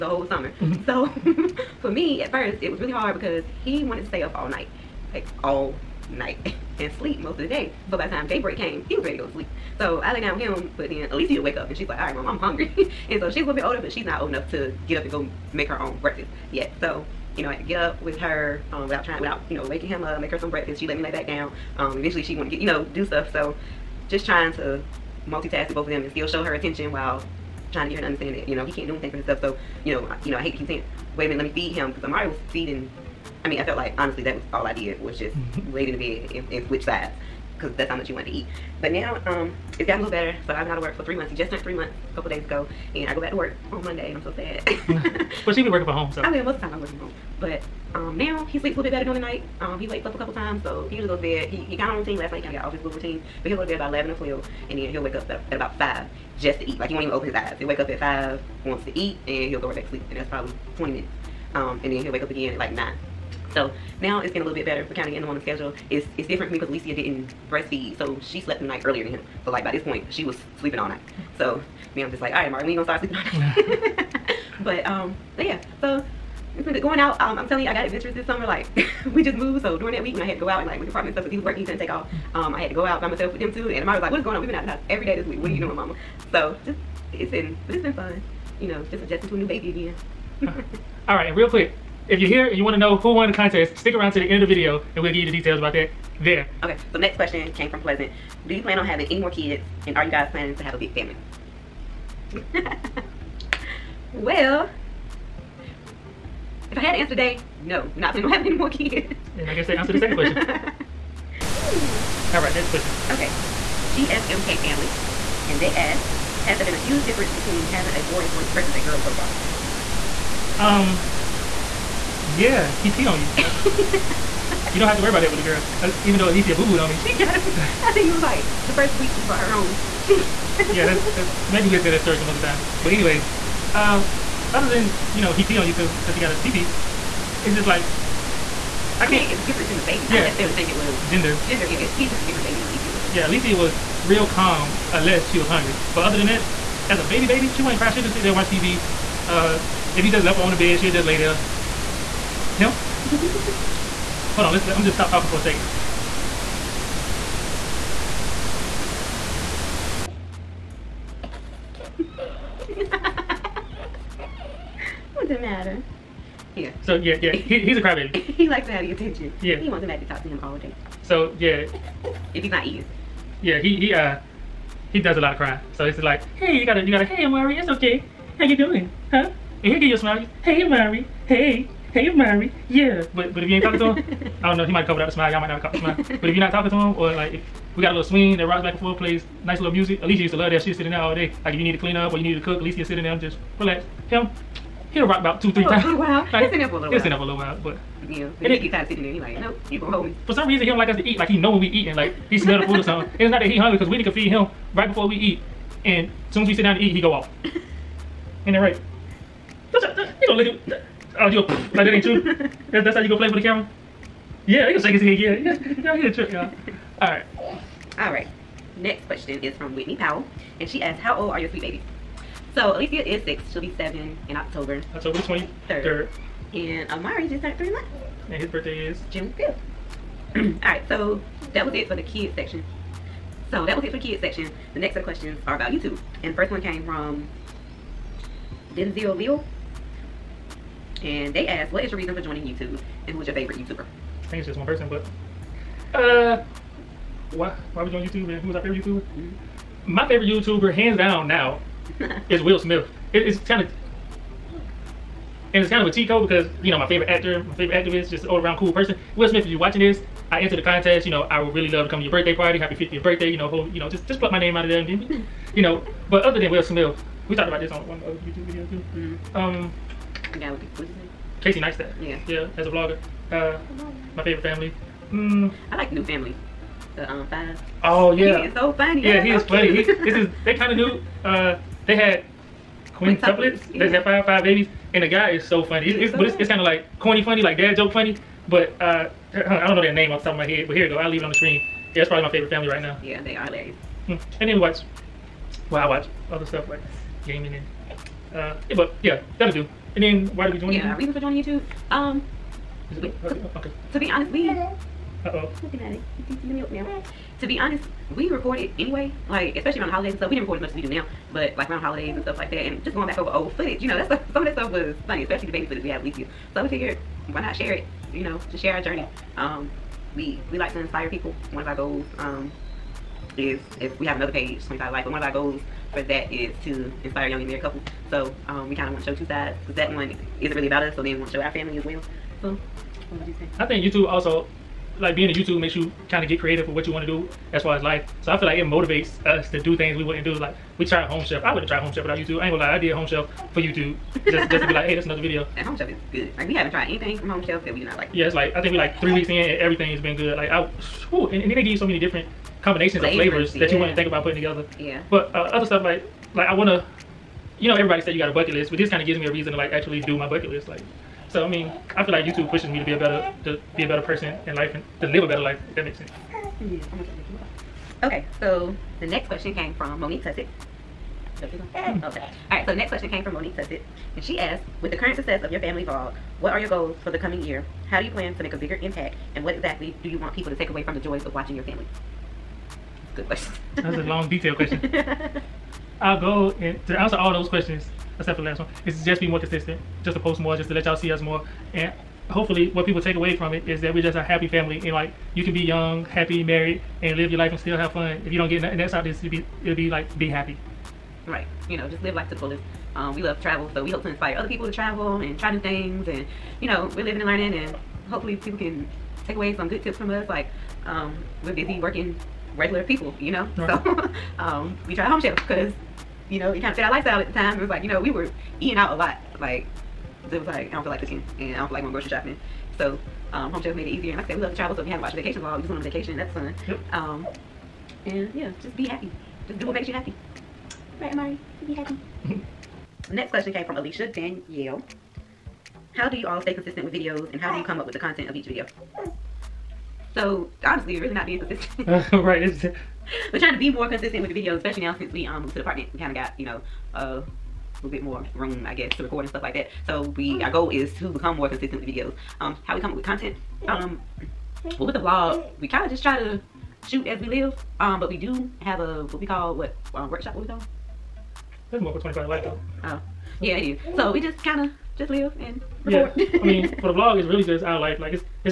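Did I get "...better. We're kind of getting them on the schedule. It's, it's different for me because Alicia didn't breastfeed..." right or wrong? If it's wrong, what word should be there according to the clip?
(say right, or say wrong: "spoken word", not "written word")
right.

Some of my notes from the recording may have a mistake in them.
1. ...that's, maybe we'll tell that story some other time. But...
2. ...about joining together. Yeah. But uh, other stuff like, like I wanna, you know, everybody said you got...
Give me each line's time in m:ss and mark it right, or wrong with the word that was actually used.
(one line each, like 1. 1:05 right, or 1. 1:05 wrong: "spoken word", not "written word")
1. 2:11 right
2. 5:54 wrong: "putting", not "joining".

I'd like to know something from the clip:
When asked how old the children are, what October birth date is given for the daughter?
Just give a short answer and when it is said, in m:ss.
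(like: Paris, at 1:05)
October 23, at 3:44.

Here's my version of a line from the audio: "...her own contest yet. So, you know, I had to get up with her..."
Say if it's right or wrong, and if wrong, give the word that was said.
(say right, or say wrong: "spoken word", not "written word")
wrong: "breakfast", not "contest".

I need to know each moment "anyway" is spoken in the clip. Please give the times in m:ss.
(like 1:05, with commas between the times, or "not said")
2:12, 5:08.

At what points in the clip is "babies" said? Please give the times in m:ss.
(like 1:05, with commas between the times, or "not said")
2:19, 3:41, 4:44.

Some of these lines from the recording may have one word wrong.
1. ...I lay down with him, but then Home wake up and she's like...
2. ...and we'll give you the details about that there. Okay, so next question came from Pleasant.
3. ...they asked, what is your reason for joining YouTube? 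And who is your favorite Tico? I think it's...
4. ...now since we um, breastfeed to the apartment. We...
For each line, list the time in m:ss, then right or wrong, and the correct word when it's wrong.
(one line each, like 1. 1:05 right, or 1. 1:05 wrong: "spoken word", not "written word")
1. 0:10 wrong: "Alicia", not "Home"
2. 1:34 right
3. 4:01 wrong: "YouTuber", not "Tico"
4. 7:24 wrong: "moved", not "breastfeed".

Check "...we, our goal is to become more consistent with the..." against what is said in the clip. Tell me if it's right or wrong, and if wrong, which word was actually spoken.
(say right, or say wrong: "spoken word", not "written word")
right.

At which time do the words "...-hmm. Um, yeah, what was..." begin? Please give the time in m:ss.
4:29.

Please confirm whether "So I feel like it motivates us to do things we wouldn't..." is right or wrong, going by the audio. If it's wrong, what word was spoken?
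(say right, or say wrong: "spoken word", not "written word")
right.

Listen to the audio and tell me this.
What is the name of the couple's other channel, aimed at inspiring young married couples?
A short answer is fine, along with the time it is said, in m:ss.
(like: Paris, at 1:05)
25 Life, at 5:24.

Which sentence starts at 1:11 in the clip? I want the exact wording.
So me, I'm just like, all right, Amari, when you gonna start sleeping all night?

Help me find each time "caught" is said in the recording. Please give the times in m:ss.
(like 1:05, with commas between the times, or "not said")
3:05.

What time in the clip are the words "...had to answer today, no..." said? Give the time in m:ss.
1:46.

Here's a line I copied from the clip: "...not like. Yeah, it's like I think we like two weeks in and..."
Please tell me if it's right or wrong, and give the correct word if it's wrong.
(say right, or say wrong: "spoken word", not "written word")
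wrong: "three", not "two".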